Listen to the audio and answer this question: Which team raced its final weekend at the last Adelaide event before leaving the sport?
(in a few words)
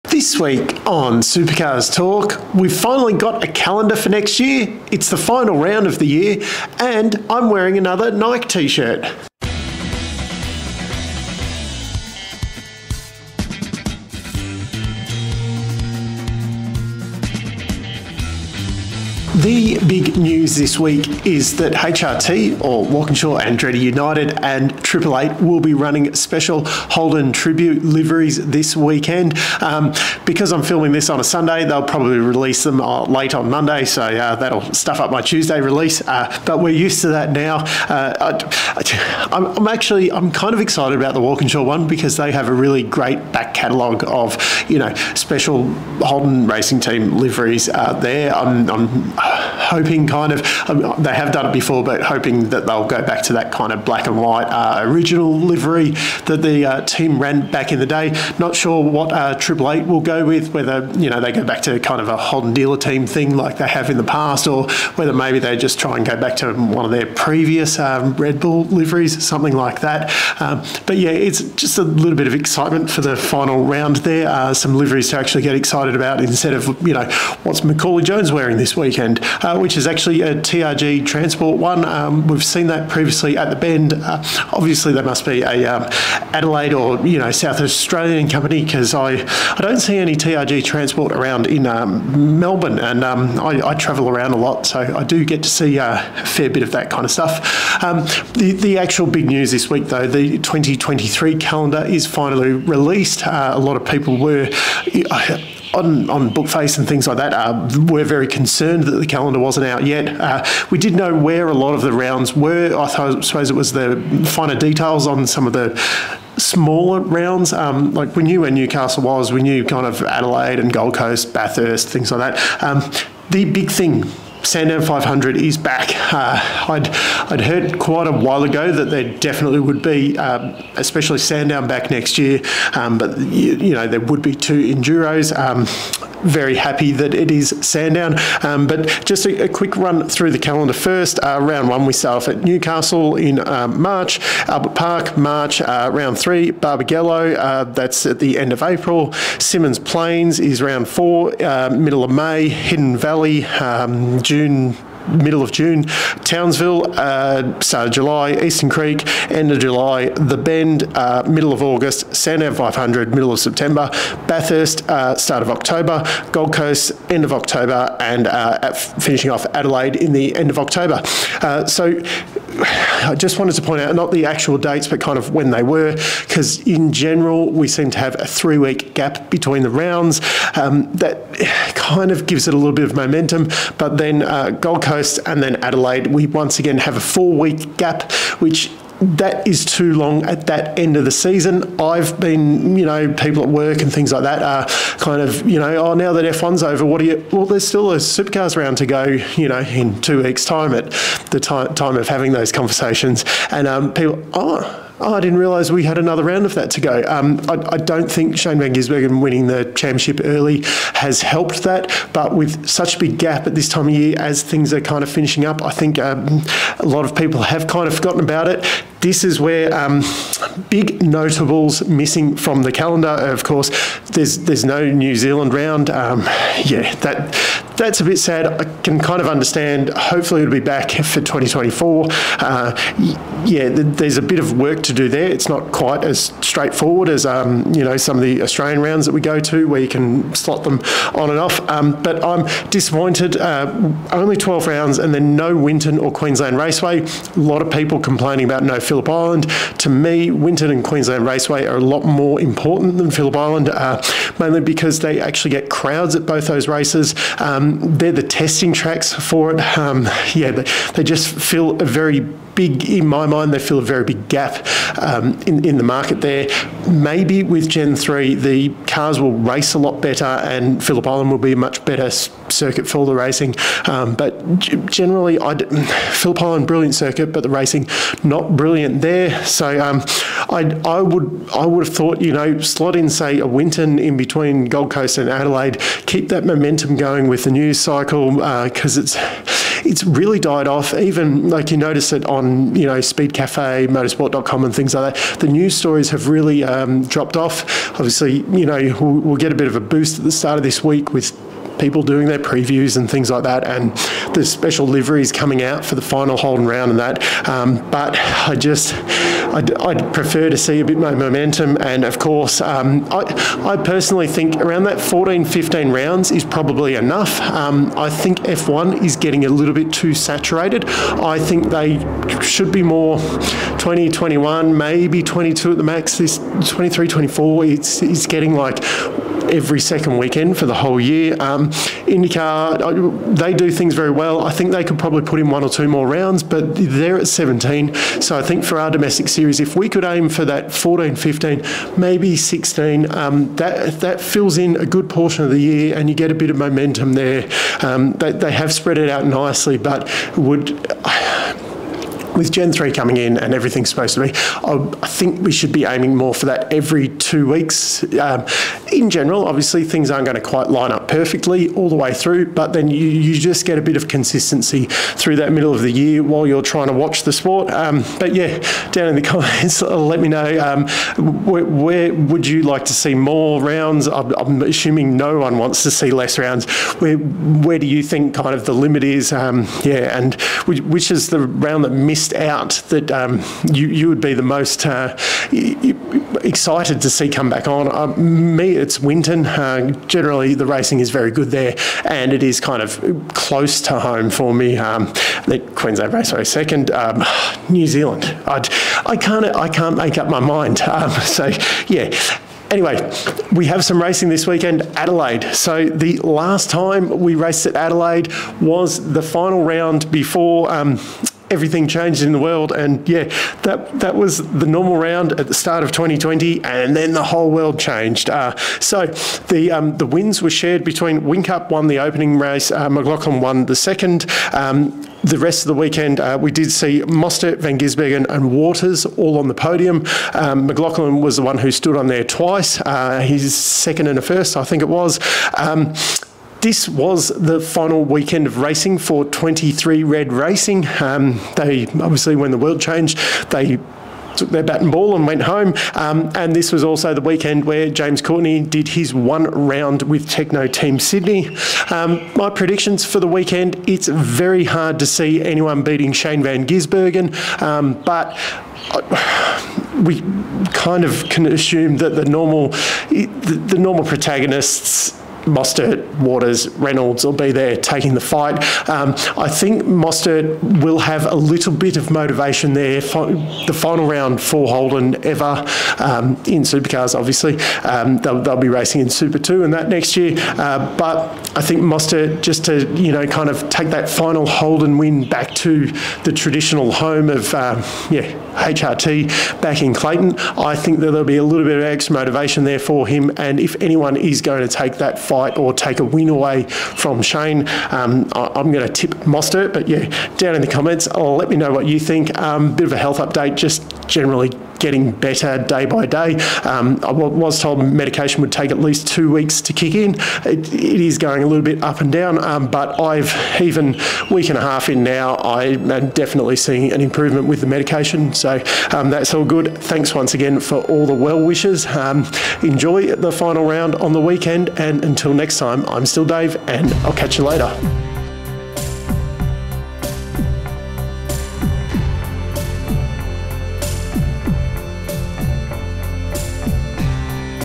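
23 Red Racing.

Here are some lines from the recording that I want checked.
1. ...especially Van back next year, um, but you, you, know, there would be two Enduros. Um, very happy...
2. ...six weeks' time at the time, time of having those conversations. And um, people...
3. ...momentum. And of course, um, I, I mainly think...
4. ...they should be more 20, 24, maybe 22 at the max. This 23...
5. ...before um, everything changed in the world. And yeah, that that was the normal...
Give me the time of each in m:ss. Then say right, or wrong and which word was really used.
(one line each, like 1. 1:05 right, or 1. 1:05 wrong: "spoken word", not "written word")
1. 2:10 wrong: "Sandown", not "Van"
2. 3:20 wrong: "two", not "six"
3. 5:11 wrong: "personally", not "mainly"
4. 5:21 wrong: "21", not "24"
5. 6:50 right.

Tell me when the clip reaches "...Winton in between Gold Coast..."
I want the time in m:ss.
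4:43.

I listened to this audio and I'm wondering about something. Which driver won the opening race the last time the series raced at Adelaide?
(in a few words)
Whincup.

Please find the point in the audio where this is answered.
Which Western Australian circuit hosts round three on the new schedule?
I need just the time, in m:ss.
2:26.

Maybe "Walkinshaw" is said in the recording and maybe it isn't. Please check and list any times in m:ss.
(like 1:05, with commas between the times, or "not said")
0:22, 0:41.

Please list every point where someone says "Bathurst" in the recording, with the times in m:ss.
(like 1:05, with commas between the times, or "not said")
2:01, 2:44.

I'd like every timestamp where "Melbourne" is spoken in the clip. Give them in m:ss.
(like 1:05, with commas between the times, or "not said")
1:32.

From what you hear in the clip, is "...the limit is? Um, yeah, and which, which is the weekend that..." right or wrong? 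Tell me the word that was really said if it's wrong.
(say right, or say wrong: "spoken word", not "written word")
wrong: "round", not "weekend".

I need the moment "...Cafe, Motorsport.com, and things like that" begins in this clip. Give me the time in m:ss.
4:53.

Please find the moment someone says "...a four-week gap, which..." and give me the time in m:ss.
3:06.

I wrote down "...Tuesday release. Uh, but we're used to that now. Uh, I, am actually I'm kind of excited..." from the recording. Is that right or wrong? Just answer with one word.
right.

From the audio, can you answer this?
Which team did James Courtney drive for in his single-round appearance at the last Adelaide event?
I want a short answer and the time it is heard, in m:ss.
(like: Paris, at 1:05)
Tekno Team Sydney, at 7:30.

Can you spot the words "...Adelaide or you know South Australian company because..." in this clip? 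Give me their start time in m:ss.
1:26.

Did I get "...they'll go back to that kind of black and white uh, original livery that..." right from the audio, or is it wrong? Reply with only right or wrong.
right.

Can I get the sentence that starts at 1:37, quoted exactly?
Um, the the actual big news this week, though, the 2023 calendar is finally released.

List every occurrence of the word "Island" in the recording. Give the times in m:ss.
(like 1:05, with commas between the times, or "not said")
4:09, 4:13, 4:31, 4:36.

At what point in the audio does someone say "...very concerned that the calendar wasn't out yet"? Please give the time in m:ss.
1:48.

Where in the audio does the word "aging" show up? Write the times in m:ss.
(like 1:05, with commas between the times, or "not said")
not said.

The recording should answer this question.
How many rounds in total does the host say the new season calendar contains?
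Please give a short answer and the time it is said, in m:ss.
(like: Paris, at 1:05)
12, at 4:04.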